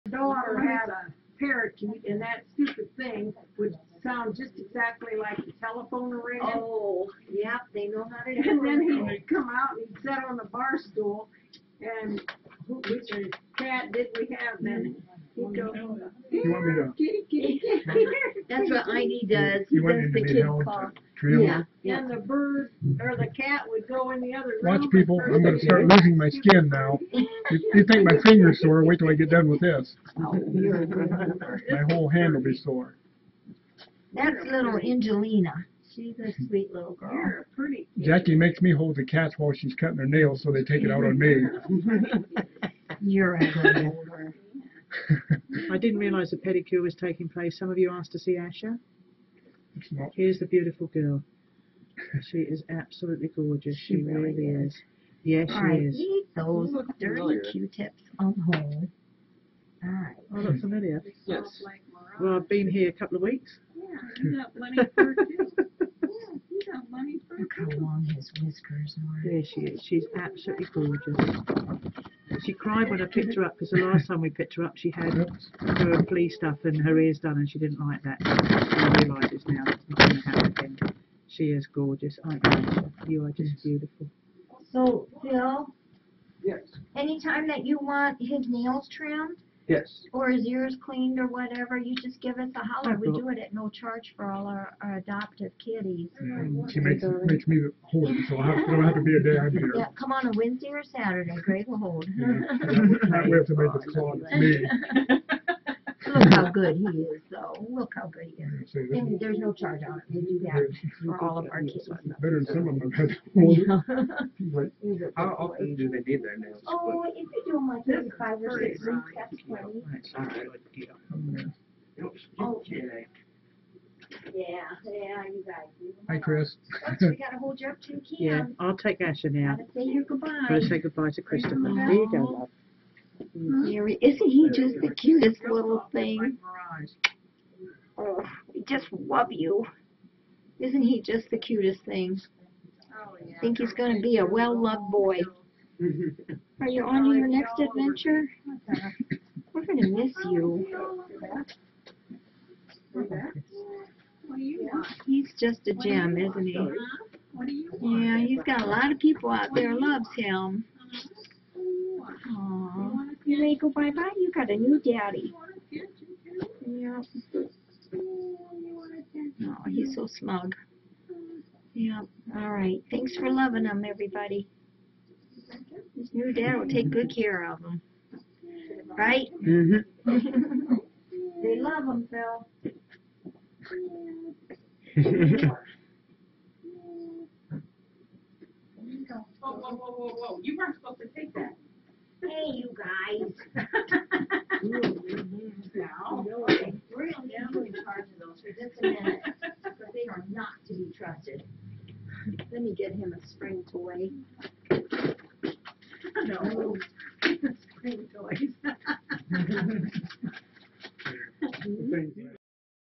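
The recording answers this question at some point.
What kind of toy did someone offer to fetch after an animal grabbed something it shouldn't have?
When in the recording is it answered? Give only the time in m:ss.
3:23.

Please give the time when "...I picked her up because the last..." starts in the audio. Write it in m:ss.
1:13.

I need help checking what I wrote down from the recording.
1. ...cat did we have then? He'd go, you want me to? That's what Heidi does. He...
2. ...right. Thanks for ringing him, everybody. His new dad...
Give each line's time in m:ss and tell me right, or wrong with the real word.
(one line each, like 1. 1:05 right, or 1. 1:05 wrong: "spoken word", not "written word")
1. 0:13 right
2. 2:52 wrong: "loving", not "ringing".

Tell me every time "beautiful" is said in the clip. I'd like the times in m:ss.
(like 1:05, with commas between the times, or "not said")
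0:50, 1:23.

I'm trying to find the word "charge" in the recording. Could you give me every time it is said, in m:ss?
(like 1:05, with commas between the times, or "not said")
1:33, 1:49, 3:17.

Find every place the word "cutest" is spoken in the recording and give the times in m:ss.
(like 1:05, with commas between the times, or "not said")
2:14, 2:21.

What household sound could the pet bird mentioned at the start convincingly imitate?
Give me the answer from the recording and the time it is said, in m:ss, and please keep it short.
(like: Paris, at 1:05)
telephone ringing, at 0:05.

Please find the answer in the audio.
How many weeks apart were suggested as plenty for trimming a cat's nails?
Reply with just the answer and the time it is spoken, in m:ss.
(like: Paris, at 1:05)
5 or 6 weeks, at 1:58.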